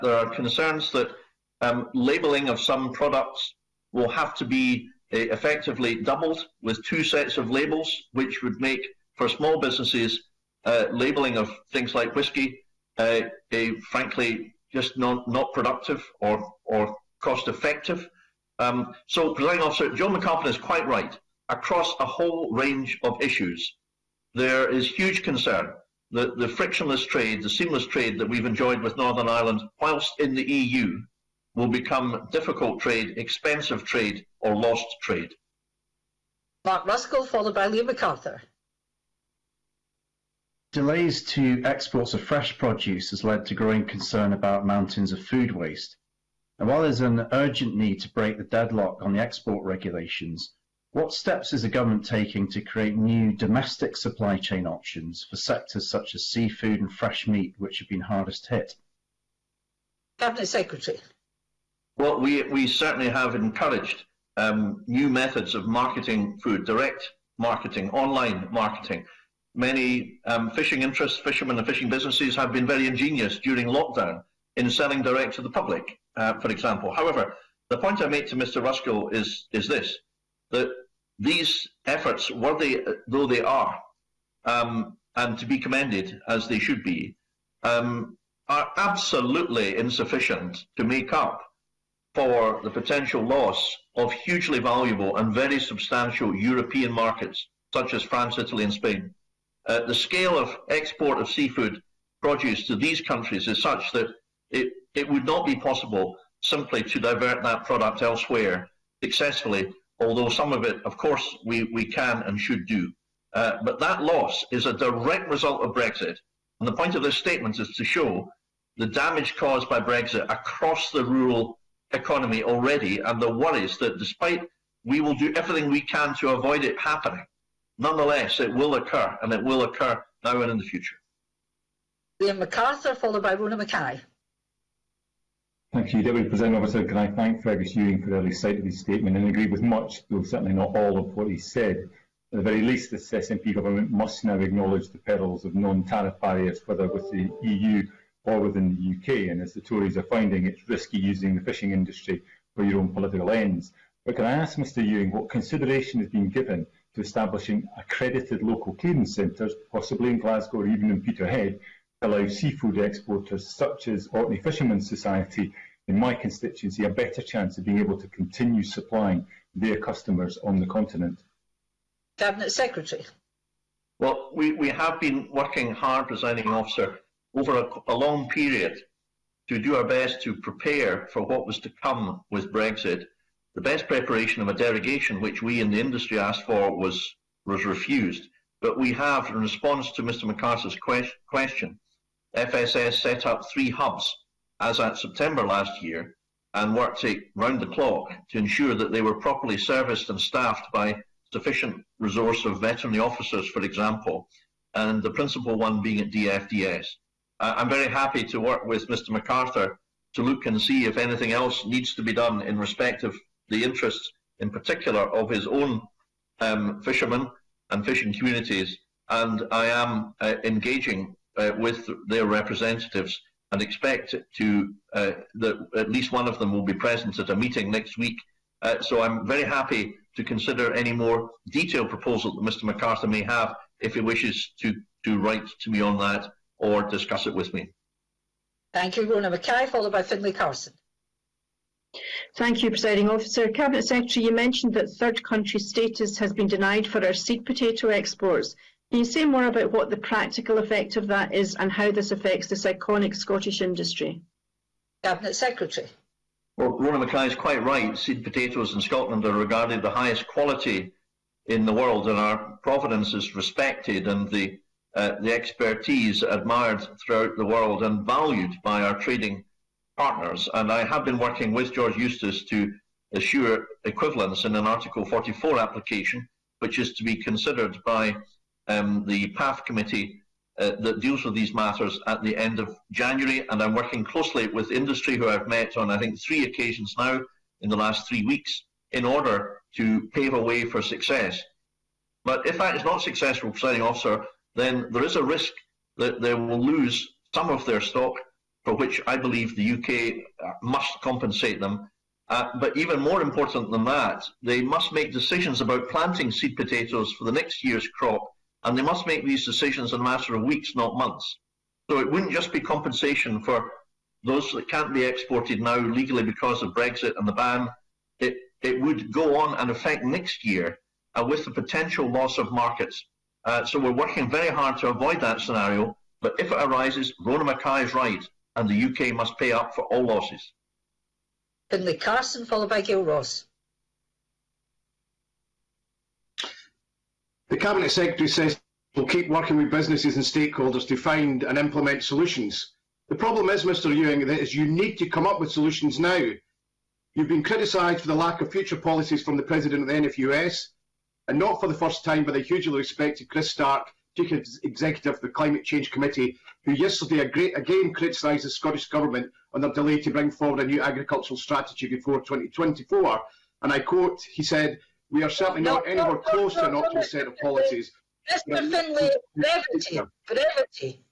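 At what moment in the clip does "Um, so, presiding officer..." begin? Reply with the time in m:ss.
0:18.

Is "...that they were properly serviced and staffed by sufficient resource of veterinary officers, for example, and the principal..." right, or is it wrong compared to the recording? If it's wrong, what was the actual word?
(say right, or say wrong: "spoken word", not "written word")
right.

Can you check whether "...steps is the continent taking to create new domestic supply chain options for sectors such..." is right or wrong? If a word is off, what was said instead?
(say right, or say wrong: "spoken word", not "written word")
wrong: "government", not "continent".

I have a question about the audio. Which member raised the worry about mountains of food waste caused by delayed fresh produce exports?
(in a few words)
Mark Ruskell.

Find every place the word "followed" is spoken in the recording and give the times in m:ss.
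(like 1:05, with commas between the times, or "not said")
0:37, 2:12, 3:59, 5:32.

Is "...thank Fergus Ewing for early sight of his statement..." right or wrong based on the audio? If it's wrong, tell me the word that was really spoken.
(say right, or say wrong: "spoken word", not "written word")
right.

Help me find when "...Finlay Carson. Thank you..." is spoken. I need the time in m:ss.
4:00.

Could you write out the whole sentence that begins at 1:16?
However, the point I make to Mr.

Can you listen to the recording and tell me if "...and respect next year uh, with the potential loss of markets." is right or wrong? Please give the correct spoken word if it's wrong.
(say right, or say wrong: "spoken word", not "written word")
wrong: "affect", not "respect".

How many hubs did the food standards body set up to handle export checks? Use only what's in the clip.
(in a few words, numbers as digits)
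3.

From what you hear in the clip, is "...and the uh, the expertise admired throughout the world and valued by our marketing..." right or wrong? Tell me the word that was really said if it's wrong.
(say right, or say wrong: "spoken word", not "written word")
wrong: "trading", not "marketing".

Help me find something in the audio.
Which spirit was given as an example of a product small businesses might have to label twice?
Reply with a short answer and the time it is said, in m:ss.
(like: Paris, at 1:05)
Whiskey, at 0:12.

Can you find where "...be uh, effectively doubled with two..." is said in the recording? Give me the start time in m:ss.
0:04.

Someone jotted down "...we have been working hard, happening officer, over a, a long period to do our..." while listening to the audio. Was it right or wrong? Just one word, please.
wrong.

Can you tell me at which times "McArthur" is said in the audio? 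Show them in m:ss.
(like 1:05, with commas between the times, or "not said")
0:37, 2:12, 3:10, 3:29, 3:52.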